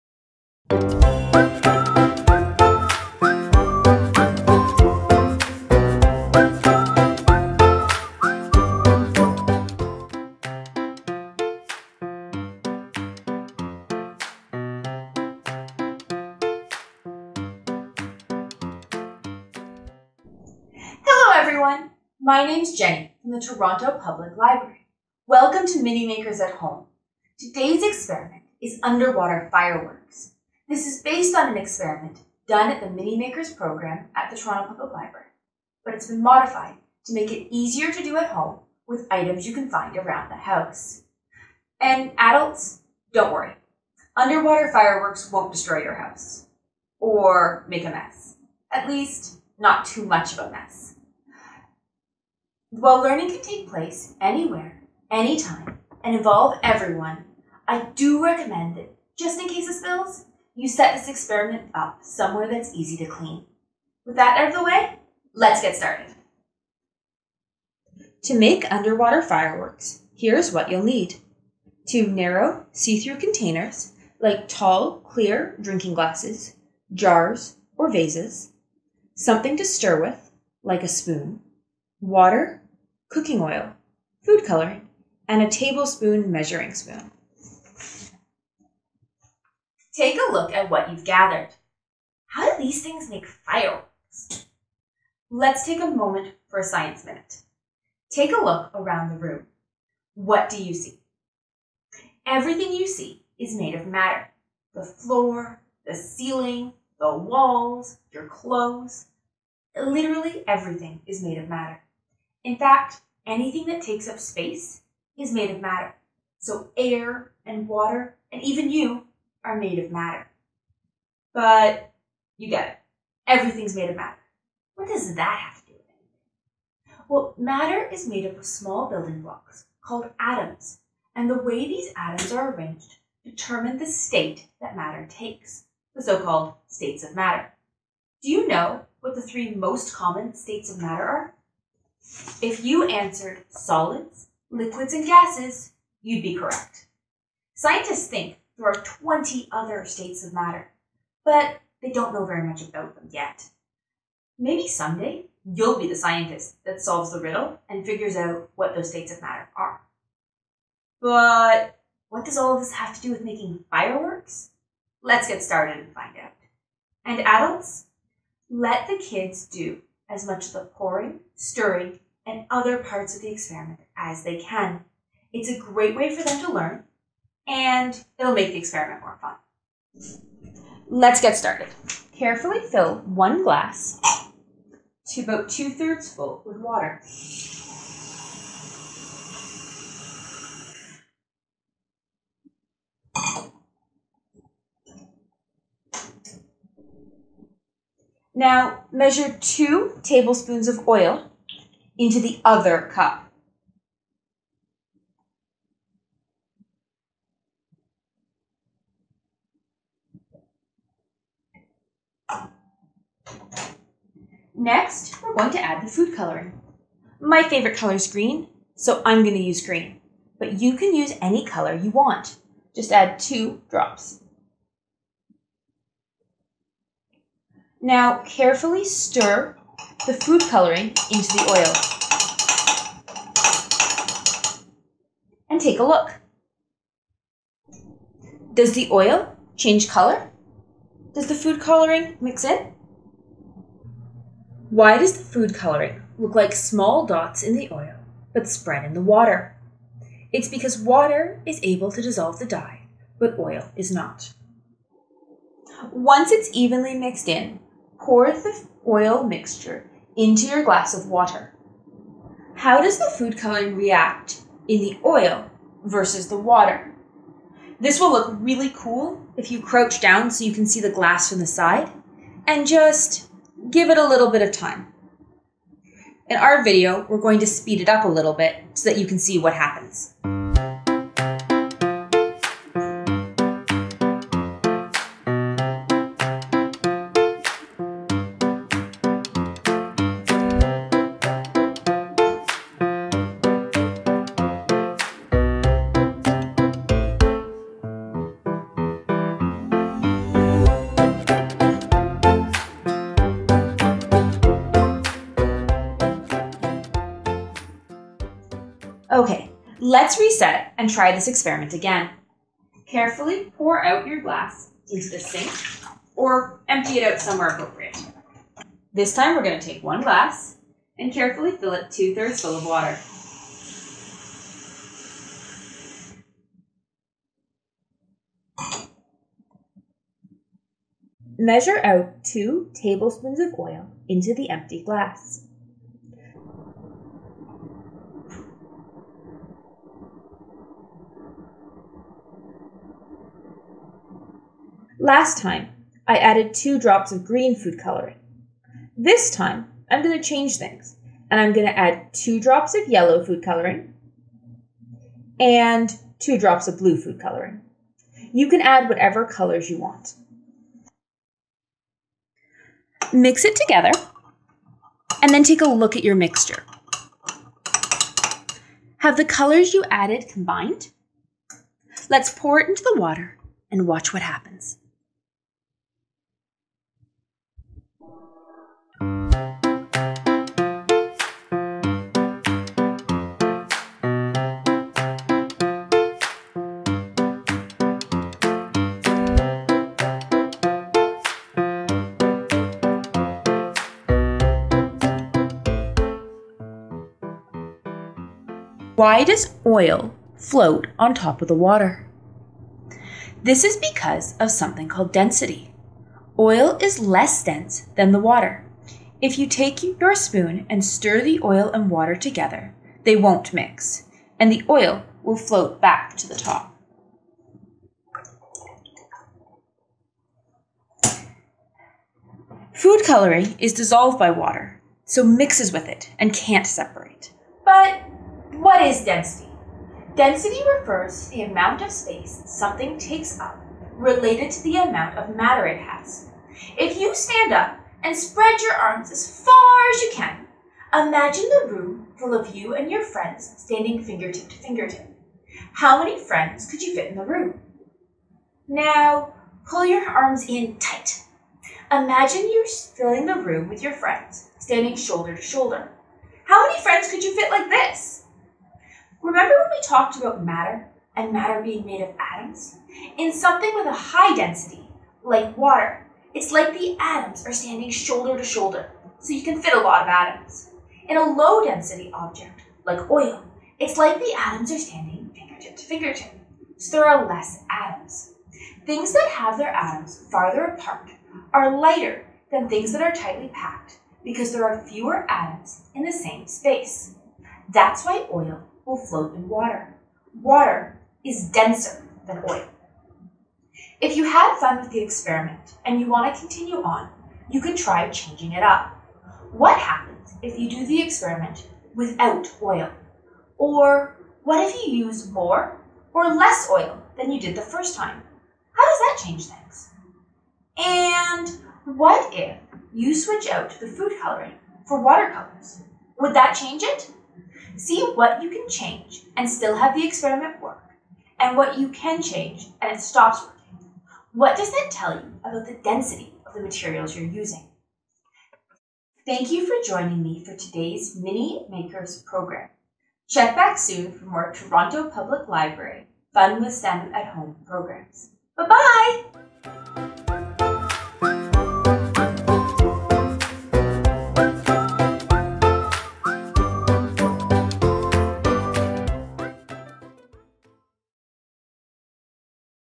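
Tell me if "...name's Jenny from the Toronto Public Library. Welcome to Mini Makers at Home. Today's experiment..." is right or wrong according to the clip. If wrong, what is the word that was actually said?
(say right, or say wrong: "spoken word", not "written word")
right.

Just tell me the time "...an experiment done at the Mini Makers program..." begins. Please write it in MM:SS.
00:31.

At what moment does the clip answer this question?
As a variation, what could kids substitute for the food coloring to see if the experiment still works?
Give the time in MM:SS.
08:35.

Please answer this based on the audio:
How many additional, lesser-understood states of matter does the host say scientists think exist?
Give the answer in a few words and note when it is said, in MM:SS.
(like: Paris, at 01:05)
20, at 02:28.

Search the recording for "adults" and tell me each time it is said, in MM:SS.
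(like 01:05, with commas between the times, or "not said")
00:42, 02:47.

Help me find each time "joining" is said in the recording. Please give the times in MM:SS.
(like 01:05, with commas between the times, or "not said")
08:49.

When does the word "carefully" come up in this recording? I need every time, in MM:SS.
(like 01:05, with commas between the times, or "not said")
03:02, 03:48, 05:12, 05:21.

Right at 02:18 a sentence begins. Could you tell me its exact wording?
Do you know what the three most common states of matter are?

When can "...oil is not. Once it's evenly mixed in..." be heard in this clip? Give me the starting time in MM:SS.
04:13.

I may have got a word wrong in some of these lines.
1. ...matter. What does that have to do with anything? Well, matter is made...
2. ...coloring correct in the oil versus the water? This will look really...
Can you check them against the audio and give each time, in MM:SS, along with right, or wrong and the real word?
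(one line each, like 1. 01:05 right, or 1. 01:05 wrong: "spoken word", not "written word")
1. 02:03 right
2. 04:23 wrong: "react", not "correct".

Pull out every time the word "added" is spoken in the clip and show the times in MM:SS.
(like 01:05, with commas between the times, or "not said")
05:46, 06:09.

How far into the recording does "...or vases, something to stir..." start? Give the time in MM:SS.
01:17.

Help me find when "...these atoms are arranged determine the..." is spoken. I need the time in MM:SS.
02:11.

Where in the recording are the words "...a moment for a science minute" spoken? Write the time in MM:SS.
01:35.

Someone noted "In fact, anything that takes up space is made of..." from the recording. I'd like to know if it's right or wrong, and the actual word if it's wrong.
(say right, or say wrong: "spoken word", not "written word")
right.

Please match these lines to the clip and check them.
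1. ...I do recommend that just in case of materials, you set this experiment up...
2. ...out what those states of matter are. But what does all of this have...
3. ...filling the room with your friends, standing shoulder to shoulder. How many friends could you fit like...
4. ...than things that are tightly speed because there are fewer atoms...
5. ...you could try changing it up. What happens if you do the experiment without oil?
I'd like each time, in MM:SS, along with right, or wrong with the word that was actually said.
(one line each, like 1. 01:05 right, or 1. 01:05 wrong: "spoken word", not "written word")
1. 00:57 wrong: "spills", not "materials"
2. 02:38 right
3. 07:32 right
4. 08:02 wrong: "packed", not "speed"
5. 08:17 right.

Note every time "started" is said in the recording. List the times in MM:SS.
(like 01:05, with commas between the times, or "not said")
01:05, 02:45, 03:01.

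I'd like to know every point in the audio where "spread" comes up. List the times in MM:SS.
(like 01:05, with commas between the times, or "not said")
04:08, 07:18.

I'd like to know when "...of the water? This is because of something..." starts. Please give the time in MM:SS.
06:41.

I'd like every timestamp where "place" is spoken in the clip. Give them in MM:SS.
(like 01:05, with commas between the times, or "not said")
00:53.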